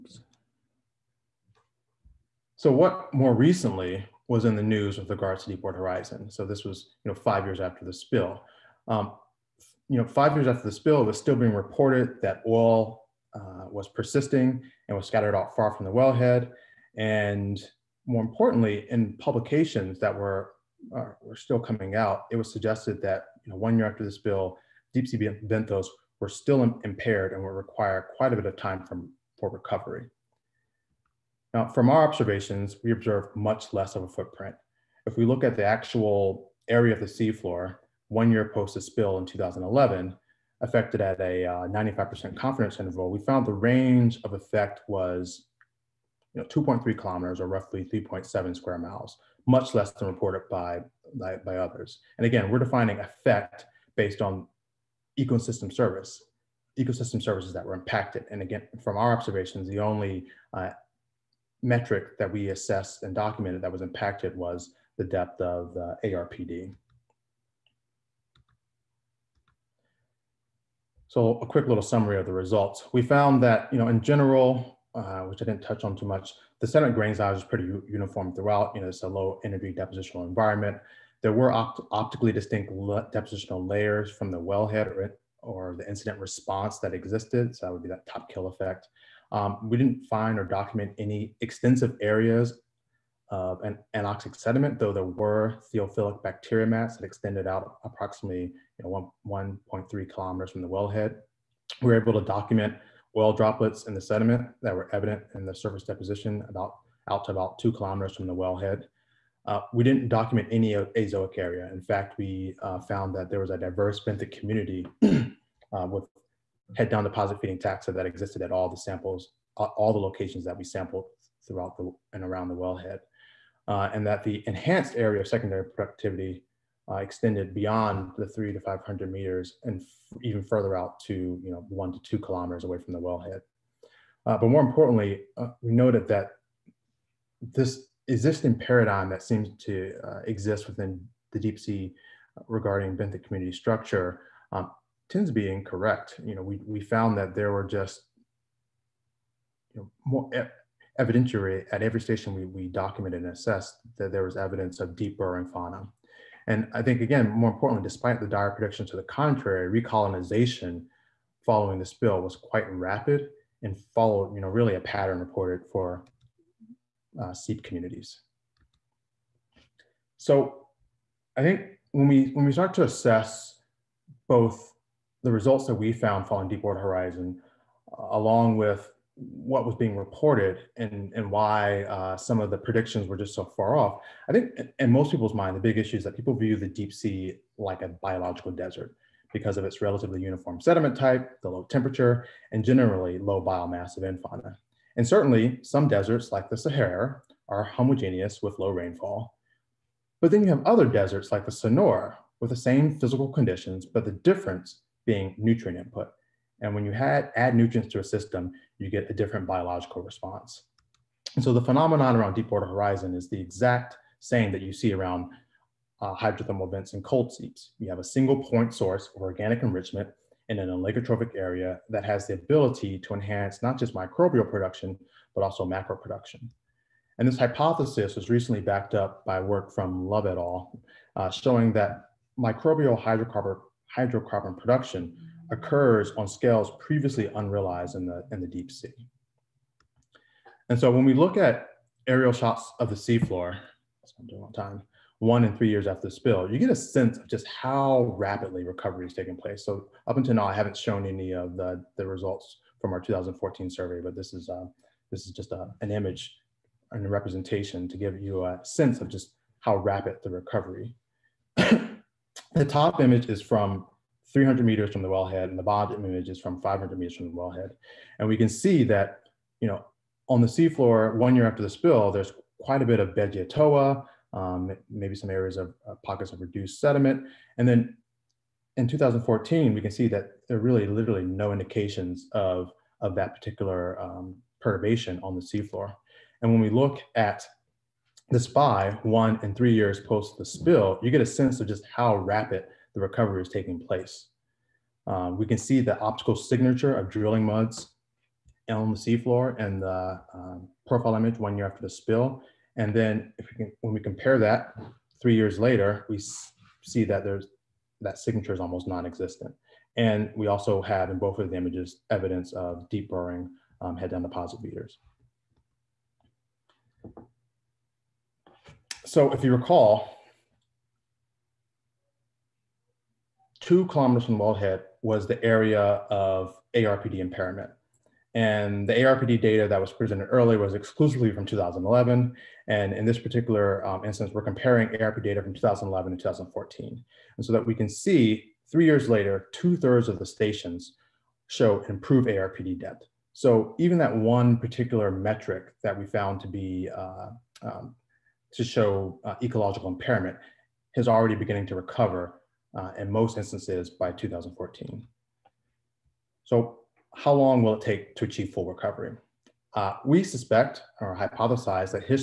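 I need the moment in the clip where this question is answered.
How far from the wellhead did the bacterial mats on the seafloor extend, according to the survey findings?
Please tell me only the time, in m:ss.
1:39.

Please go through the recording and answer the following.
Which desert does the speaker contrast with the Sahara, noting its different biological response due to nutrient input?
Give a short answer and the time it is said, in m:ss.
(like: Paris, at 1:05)
Sonora, at 3:21.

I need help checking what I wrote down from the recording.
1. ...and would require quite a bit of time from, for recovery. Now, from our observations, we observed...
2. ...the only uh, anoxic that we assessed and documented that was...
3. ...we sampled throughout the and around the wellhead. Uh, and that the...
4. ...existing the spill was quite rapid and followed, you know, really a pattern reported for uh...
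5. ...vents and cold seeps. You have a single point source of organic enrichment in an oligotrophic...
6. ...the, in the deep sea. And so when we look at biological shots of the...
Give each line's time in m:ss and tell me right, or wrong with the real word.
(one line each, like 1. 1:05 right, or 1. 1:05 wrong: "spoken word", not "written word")
1. 0:27 right
2. 0:59 wrong: "metric", not "anoxic"
3. 2:00 right
4. 2:41 wrong: "following", not "existing"
5. 3:36 right
6. 3:58 wrong: "aerial", not "biological".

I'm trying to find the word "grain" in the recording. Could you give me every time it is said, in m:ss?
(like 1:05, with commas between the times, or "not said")
1:16.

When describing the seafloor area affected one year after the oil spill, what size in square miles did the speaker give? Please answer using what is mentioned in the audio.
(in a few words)
3.7 square miles.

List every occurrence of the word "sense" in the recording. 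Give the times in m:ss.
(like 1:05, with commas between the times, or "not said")
4:06, 4:18, 4:51.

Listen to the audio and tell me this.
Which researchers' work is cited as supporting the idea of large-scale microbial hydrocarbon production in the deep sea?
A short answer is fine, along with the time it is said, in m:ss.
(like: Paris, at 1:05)
Love et al., at 3:50.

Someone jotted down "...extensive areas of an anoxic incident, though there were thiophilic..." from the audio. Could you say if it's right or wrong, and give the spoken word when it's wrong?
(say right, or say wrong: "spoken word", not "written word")
wrong: "sediment", not "incident".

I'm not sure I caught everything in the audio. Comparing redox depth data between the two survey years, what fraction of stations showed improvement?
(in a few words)
two thirds.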